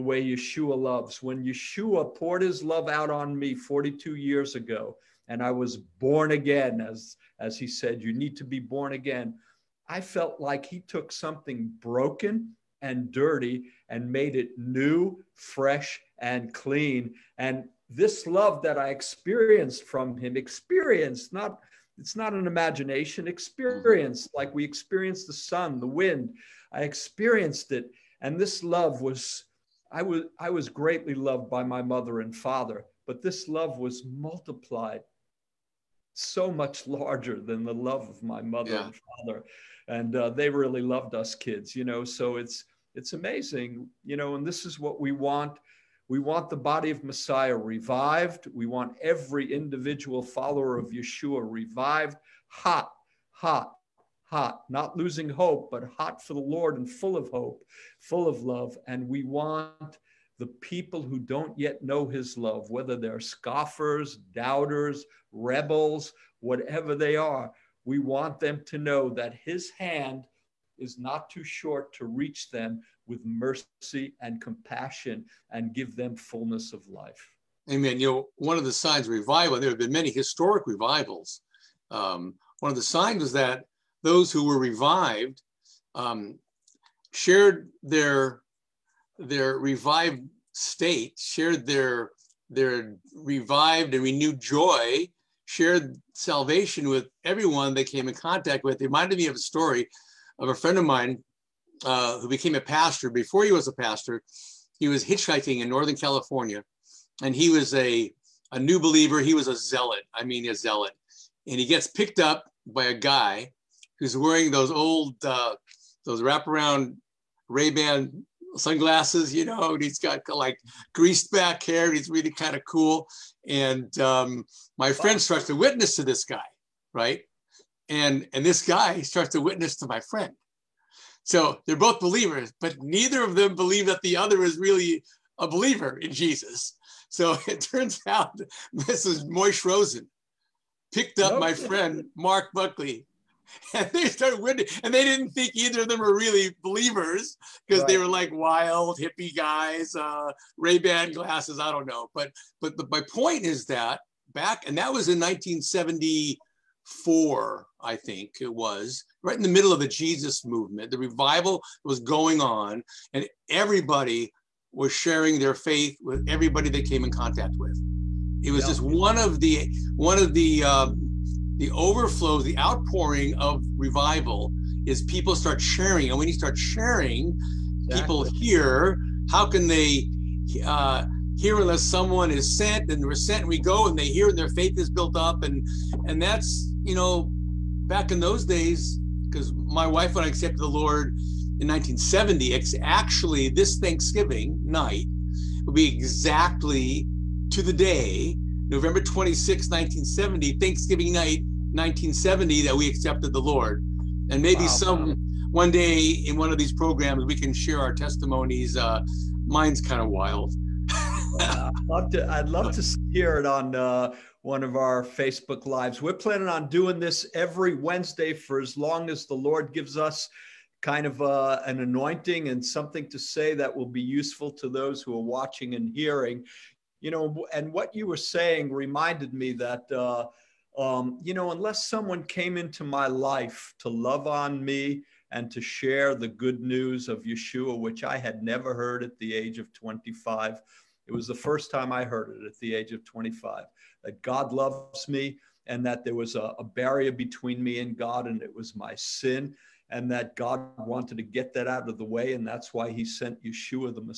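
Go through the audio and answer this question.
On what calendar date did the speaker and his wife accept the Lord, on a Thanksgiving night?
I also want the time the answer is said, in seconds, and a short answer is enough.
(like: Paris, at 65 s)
November 26, 1970, at 198 s.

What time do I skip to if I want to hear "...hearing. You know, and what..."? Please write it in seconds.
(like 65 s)
225 s.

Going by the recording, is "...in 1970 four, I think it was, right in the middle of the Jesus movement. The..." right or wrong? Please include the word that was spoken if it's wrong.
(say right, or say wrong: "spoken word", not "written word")
right.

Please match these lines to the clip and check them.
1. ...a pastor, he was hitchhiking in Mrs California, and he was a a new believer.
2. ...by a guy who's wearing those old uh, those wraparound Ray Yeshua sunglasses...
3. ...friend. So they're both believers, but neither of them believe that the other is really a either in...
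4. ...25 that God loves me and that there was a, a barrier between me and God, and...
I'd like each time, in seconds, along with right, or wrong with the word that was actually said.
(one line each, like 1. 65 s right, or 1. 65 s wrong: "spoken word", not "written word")
1. 103 s wrong: "Northern", not "Mrs"
2. 112 s wrong: "Ban", not "Yeshua"
3. 129 s wrong: "believer", not "either"
4. 243 s right.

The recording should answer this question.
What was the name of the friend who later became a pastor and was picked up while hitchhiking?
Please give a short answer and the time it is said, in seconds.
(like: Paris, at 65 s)
Mark Buckley, at 142 s.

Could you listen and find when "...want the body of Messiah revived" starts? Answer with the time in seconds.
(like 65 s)
46 s.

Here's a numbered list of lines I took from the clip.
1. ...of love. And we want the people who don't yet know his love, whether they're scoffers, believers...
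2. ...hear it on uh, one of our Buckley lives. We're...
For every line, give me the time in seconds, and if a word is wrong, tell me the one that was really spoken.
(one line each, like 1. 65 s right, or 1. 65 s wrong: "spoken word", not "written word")
1. 58 s wrong: "doubters", not "believers"
2. 213 s wrong: "Facebook", not "Buckley".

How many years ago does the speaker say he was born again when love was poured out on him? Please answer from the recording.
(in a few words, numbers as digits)
42.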